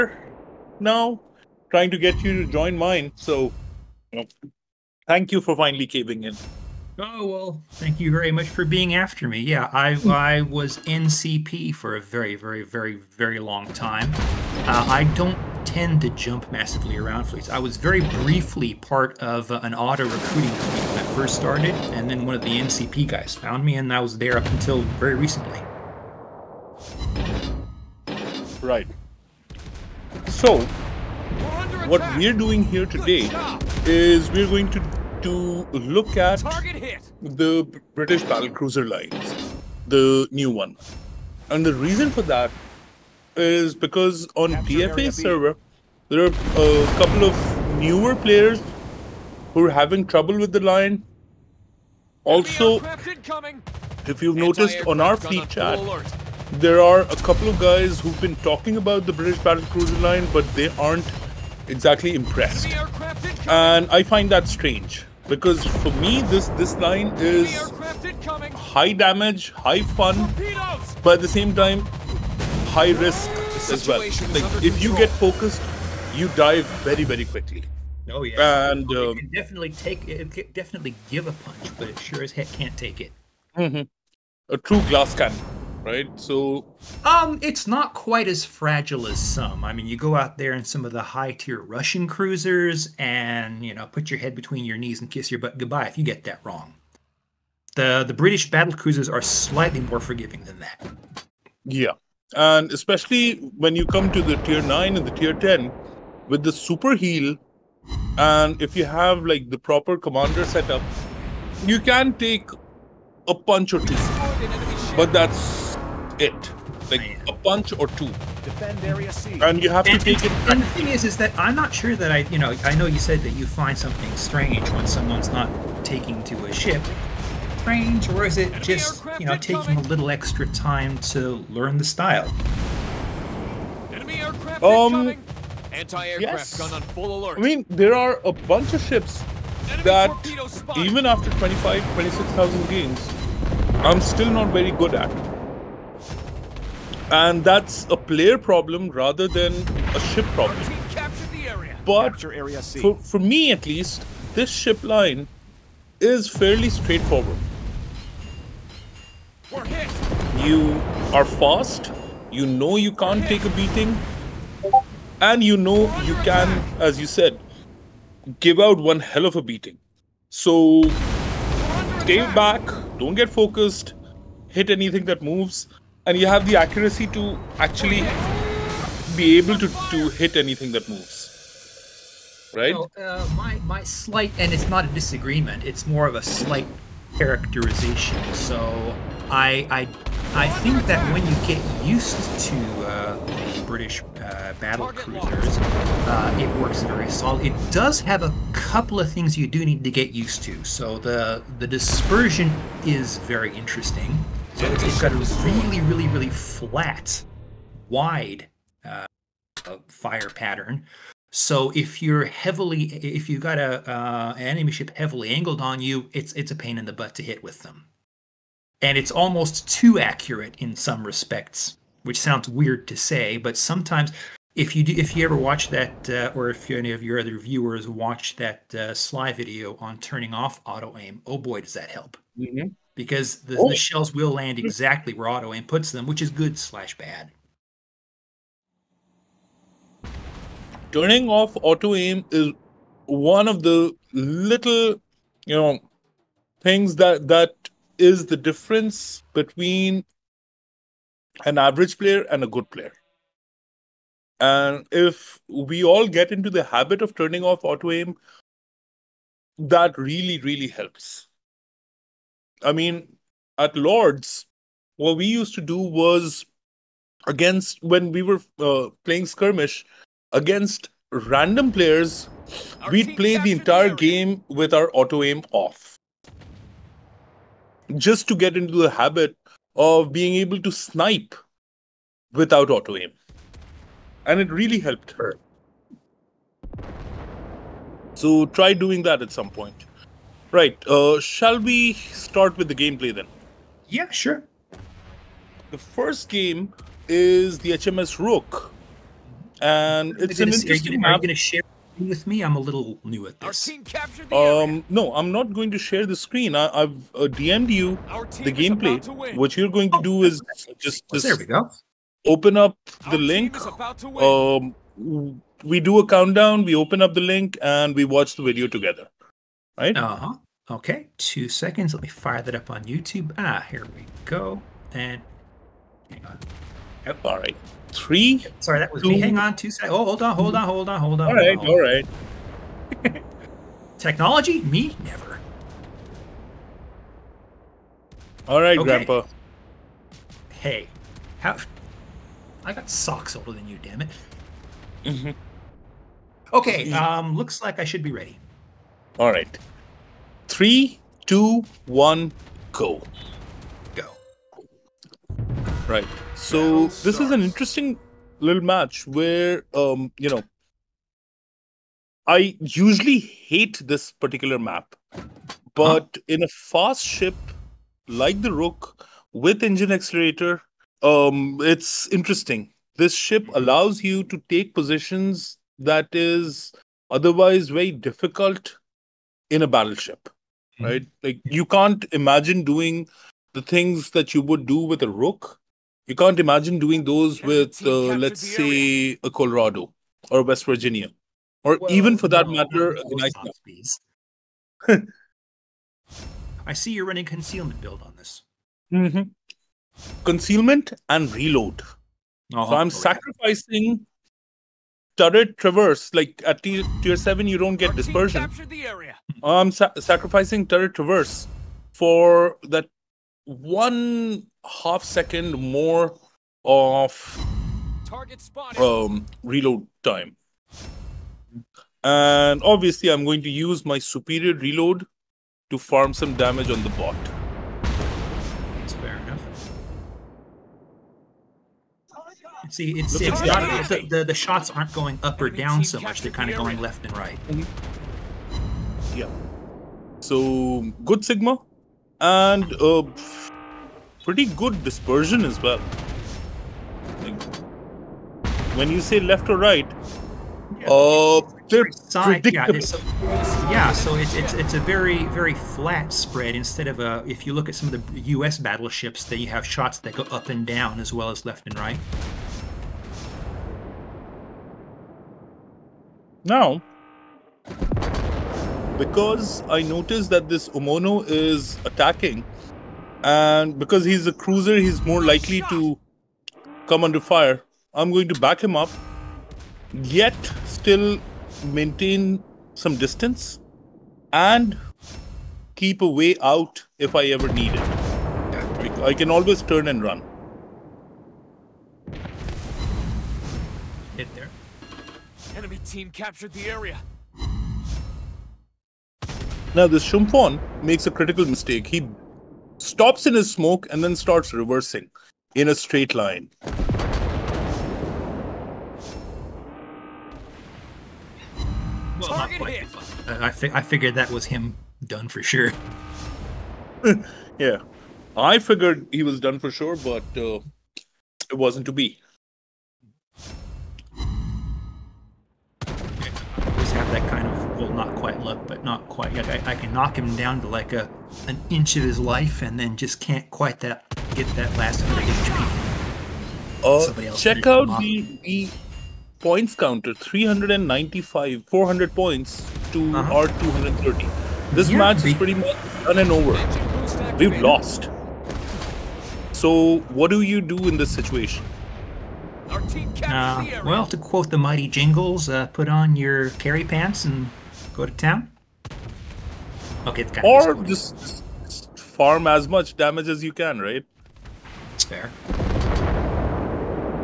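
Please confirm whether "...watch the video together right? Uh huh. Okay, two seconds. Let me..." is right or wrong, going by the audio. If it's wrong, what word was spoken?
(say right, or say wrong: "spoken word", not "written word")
right.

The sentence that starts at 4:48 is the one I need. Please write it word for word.
So try doing that at some point.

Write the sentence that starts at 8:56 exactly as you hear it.
Oh, check out the, the points counter: 395, 400 points to uh -huh.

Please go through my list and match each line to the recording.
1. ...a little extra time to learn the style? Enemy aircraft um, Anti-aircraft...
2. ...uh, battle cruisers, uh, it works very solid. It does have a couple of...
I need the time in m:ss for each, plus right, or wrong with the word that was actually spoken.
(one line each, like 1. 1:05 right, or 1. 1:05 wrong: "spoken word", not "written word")
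1. 2:09 right
2. 3:14 right.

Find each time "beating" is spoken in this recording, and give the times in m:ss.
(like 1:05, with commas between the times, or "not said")
2:43, 2:49.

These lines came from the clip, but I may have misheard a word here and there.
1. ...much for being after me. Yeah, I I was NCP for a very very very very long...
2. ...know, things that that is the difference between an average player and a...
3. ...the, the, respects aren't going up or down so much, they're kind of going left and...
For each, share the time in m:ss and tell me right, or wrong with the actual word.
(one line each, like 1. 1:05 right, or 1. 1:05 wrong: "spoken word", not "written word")
1. 0:08 right
2. 4:05 right
3. 7:14 wrong: "shots", not "respects".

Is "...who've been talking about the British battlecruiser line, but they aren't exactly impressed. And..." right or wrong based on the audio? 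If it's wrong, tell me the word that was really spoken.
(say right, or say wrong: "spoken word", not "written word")
right.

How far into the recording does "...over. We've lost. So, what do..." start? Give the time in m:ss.
9:06.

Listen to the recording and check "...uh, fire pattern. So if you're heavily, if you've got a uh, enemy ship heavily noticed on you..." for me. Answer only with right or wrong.
wrong.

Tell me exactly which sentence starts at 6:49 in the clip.
I'm sa sacrificing turret traverse for that one half second more of um, reload time.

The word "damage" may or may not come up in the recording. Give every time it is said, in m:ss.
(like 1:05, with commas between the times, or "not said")
1:08, 7:06, 9:22.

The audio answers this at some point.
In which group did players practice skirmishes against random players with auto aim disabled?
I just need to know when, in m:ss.
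4:23.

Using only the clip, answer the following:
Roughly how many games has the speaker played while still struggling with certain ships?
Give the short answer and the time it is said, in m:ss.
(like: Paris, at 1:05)
25,000 to 26,000, at 2:21.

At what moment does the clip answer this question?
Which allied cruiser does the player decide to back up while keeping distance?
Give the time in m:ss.
7:50.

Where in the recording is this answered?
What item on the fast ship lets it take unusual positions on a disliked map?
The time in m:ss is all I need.
6:09.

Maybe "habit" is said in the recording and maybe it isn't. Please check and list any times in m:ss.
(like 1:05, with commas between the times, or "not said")
4:16, 4:38.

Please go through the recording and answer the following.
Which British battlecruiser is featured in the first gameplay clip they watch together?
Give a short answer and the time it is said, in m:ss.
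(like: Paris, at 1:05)
HMS Rooke, at 4:57.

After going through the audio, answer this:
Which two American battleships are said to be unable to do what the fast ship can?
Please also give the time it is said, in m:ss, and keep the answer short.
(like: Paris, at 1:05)
Colorado or West Virginia, at 6:29.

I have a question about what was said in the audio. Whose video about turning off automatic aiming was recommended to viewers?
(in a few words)
Sly.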